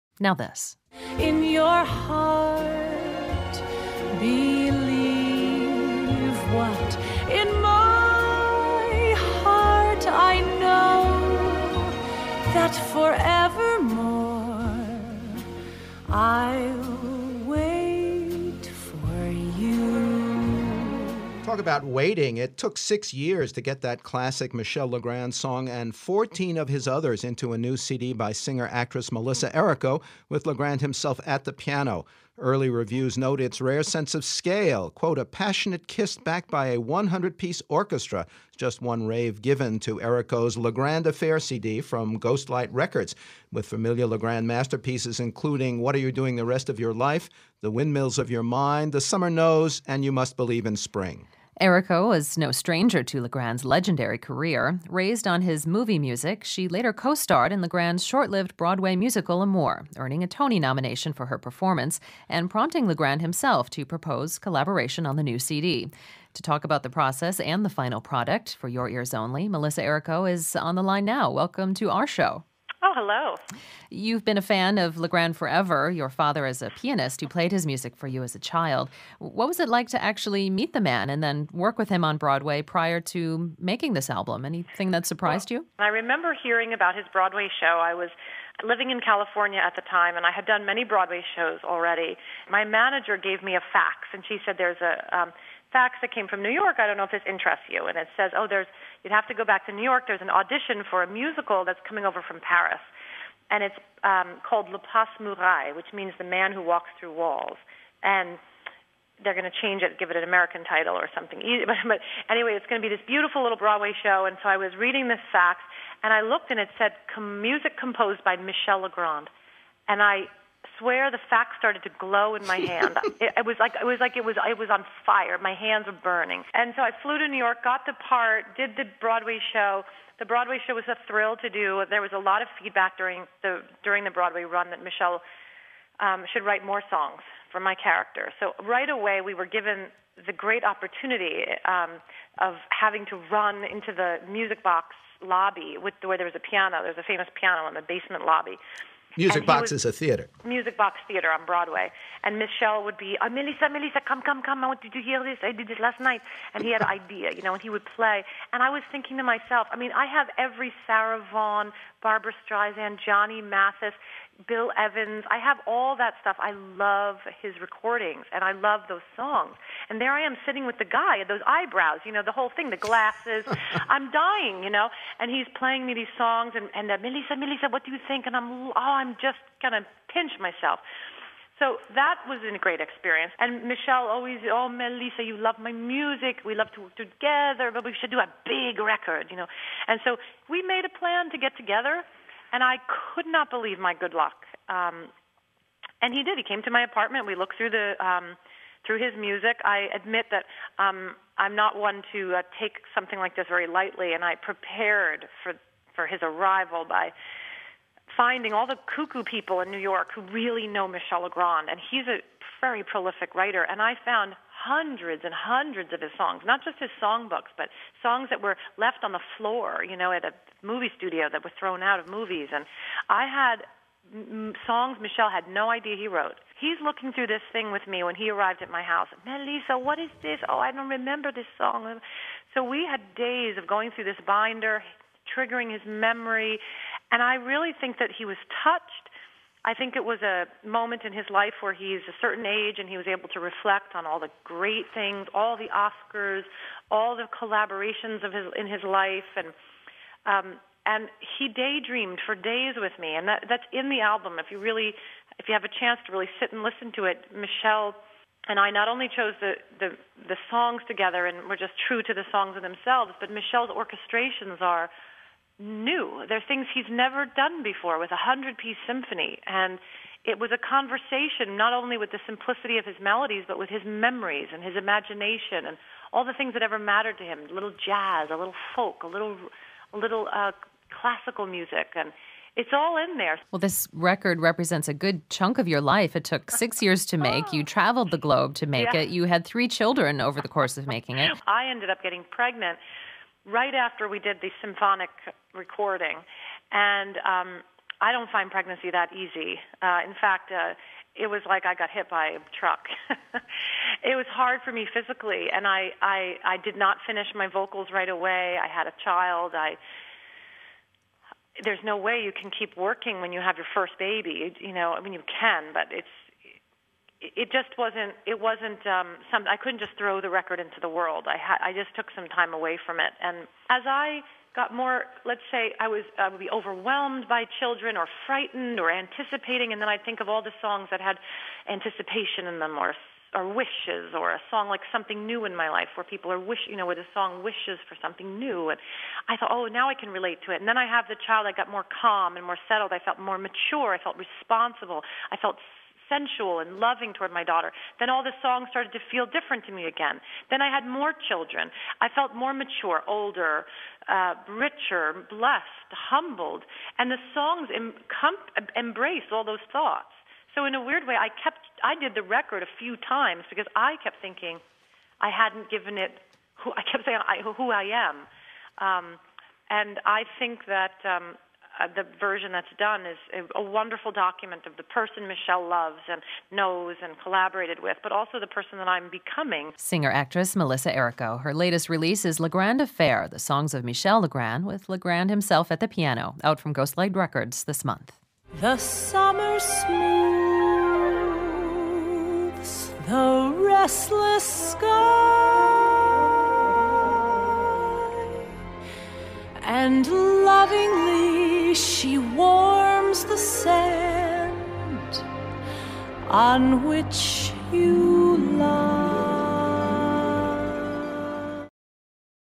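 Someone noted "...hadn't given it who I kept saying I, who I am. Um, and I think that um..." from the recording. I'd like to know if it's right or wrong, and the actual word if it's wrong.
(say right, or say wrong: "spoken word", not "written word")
right.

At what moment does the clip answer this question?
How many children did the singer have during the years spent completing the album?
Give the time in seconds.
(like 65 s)
289 s.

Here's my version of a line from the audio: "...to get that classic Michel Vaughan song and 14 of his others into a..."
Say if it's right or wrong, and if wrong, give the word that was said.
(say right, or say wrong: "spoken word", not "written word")
wrong: "Legrand", not "Vaughan".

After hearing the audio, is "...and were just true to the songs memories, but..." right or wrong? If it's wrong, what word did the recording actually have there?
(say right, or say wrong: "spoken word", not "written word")
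wrong: "themselves", not "memories".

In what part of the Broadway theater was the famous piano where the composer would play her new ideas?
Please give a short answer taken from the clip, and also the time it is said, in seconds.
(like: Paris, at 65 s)
basement lobby, at 147 s.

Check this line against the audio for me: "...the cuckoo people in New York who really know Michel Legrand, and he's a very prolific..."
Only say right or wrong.
right.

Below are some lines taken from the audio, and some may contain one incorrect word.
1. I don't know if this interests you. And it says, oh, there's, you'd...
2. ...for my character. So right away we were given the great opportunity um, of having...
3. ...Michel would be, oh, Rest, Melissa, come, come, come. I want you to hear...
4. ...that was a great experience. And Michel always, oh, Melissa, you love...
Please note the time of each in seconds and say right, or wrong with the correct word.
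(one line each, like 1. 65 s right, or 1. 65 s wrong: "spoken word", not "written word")
1. 96 s right
2. 137 s right
3. 152 s wrong: "Melissa", not "Rest"
4. 181 s right.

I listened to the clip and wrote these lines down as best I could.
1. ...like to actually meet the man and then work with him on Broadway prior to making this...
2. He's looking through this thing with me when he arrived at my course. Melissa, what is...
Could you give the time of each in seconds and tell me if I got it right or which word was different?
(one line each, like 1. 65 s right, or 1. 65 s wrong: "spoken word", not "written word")
1. 79 s right
2. 226 s wrong: "house", not "course".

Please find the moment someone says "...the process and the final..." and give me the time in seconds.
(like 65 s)
66 s.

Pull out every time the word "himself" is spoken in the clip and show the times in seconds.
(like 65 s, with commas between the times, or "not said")
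30 s, 63 s, 385 s.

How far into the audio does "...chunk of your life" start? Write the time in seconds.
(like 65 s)
285 s.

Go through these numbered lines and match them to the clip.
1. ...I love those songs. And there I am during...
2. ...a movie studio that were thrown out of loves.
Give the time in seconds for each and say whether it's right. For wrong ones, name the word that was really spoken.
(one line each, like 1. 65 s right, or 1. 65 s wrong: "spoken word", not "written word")
1. 168 s wrong: "sitting", not "during"
2. 220 s wrong: "movies", not "loves".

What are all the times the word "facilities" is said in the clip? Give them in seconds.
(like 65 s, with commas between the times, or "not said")
not said.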